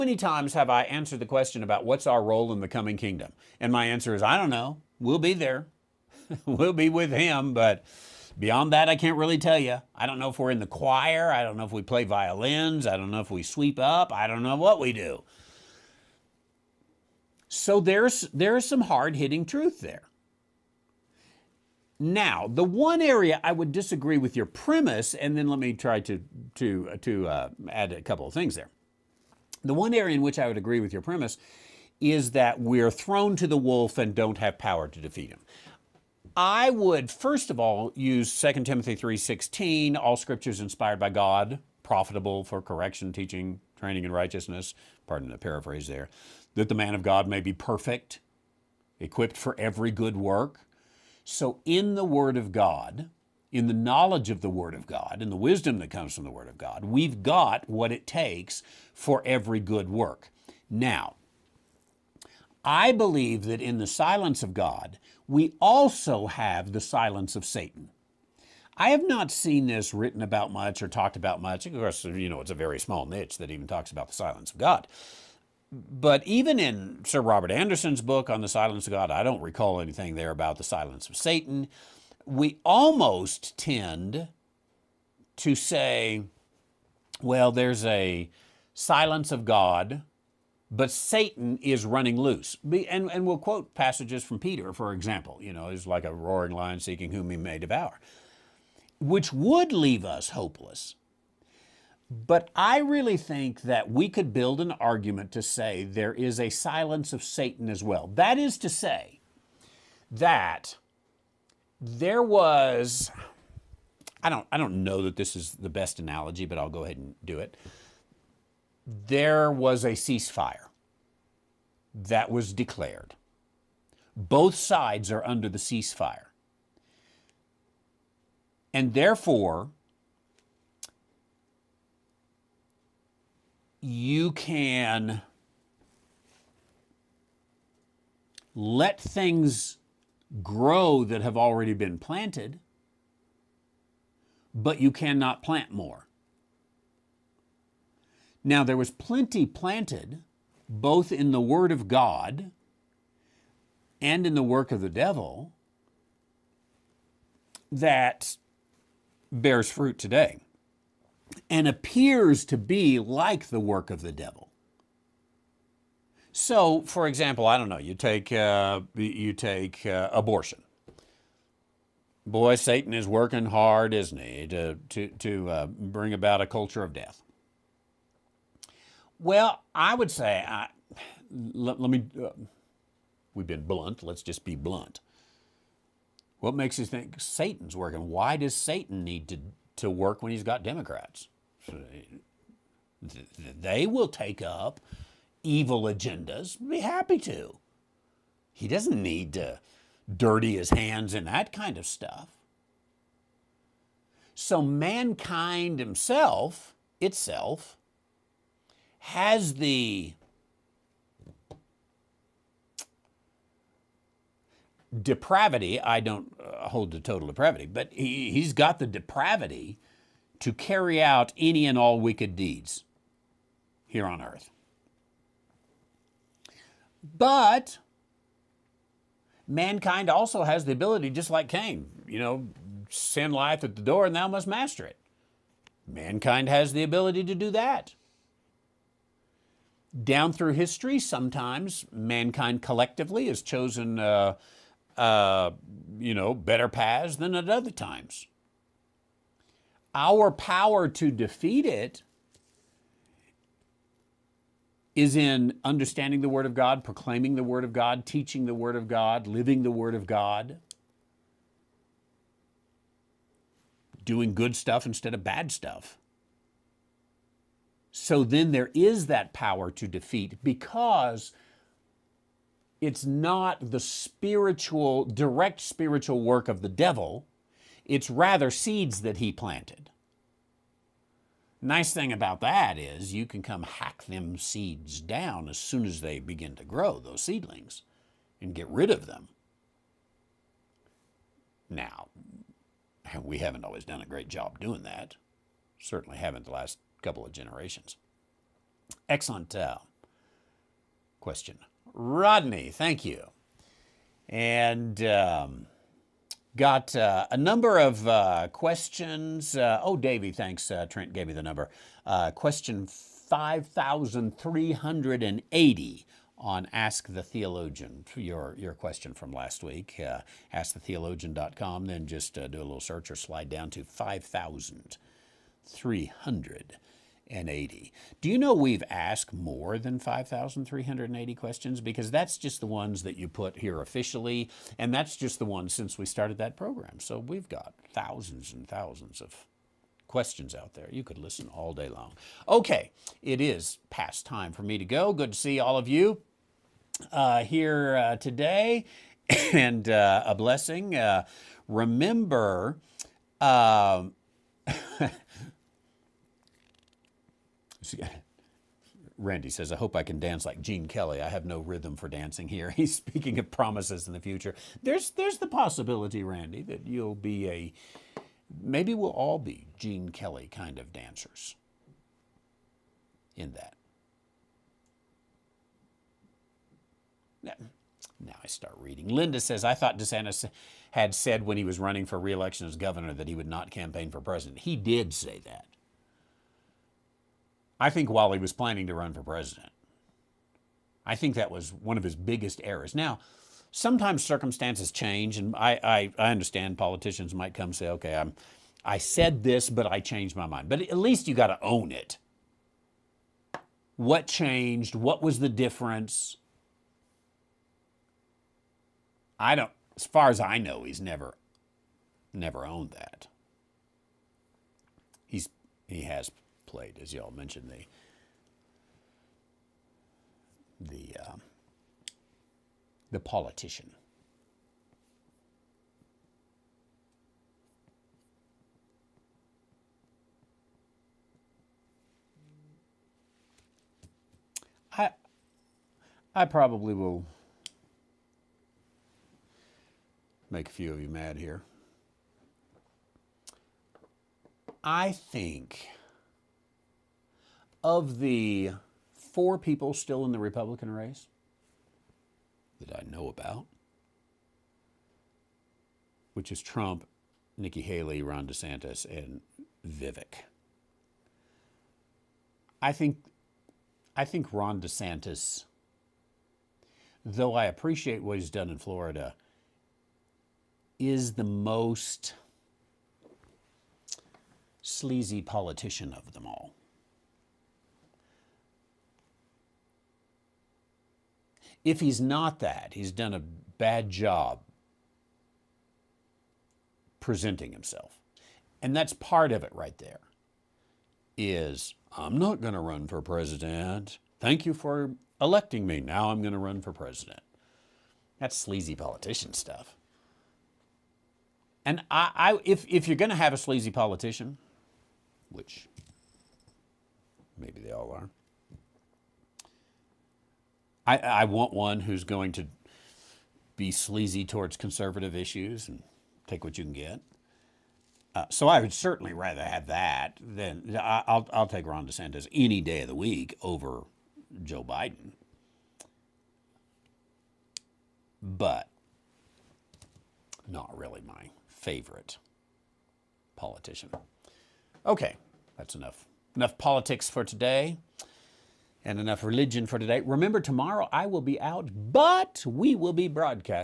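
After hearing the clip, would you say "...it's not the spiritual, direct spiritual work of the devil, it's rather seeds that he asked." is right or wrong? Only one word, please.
wrong.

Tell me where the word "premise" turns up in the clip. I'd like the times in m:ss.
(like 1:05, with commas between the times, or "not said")
0:24, 0:31.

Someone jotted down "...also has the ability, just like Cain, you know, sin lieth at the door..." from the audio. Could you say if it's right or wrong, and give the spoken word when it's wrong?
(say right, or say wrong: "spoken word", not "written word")
right.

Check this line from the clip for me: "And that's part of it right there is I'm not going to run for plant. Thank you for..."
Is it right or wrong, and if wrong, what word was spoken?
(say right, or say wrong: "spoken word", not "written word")
wrong: "president", not "plant".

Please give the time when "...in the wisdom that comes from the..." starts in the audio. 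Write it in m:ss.
0:55.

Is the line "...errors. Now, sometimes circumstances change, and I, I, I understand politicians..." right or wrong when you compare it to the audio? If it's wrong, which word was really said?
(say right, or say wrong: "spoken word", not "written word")
right.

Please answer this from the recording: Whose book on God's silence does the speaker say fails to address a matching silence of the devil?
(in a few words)
Sir Robert Anderson.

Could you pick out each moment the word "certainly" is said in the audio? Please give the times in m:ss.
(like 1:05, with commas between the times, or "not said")
4:55, 8:38.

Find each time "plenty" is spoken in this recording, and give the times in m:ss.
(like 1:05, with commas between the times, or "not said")
2:28.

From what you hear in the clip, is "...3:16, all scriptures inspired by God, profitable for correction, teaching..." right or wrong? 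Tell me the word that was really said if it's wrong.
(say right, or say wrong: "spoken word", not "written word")
right.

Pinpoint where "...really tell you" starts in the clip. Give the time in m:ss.
0:09.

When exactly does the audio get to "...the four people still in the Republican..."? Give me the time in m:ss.
7:28.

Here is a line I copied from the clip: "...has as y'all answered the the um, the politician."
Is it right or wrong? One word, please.
wrong.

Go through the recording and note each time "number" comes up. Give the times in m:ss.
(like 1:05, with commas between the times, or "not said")
5:07, 5:11.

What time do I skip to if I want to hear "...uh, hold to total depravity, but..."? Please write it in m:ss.
3:36.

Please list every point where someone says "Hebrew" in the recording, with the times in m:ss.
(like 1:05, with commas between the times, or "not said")
not said.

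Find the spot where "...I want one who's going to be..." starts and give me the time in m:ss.
8:31.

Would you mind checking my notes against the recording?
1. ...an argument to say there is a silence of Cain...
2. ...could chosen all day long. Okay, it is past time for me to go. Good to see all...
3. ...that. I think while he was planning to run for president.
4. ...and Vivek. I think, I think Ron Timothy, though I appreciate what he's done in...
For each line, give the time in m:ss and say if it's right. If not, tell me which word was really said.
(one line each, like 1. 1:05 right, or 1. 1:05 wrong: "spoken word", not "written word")
1. 1:44 wrong: "Satan", not "Cain"
2. 5:41 wrong: "listen", not "chosen"
3. 6:25 right
4. 7:39 wrong: "DeSantis", not "Timothy".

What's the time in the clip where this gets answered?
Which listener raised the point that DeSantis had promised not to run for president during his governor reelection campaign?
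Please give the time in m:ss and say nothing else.
6:19.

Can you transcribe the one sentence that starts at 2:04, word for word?
Both sides are under the ceasefire.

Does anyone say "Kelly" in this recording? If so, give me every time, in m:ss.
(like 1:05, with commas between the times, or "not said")
6:00, 6:10.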